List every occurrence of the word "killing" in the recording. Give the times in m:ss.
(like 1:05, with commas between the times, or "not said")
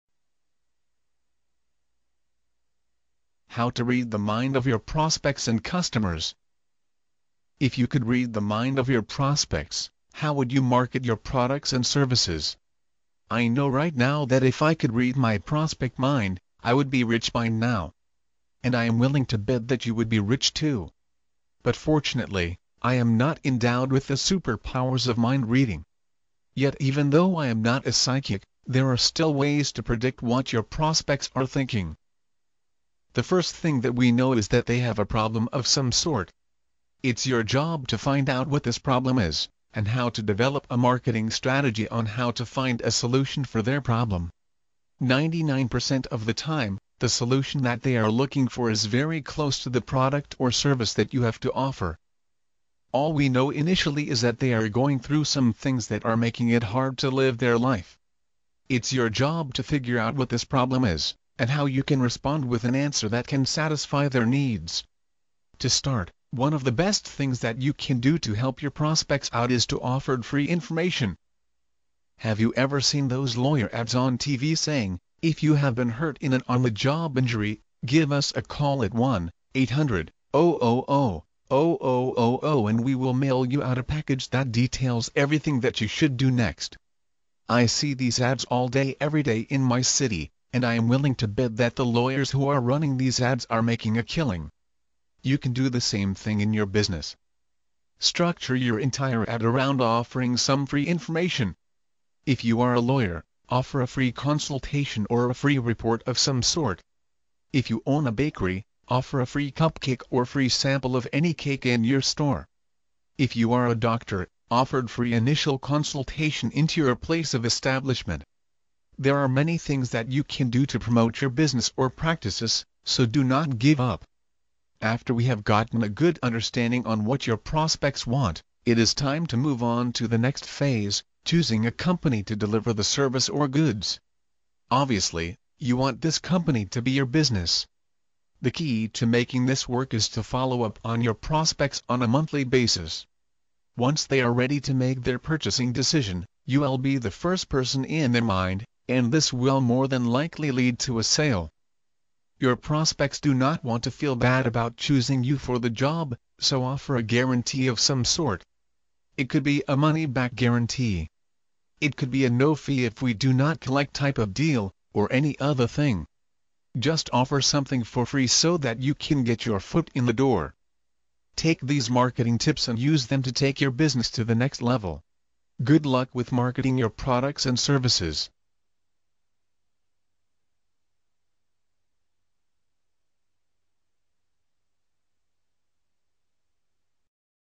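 1:34.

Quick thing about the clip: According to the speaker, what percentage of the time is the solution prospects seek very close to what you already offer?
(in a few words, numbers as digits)
99%.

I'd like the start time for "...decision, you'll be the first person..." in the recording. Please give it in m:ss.
2:25.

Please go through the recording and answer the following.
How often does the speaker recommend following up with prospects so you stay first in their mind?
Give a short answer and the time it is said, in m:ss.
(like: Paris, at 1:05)
Monthly, at 2:22.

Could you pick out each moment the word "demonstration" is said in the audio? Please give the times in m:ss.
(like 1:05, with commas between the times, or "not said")
not said.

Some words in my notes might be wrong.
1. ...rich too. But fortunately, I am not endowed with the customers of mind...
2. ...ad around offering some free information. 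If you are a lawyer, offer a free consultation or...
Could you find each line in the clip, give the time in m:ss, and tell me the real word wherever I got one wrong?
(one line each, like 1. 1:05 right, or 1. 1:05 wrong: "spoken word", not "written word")
1. 0:20 wrong: "superpowers", not "customers"
2. 1:39 right.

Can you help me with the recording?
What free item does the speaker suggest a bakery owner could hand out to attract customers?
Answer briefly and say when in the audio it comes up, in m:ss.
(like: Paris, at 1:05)
A free cupcake, at 1:49.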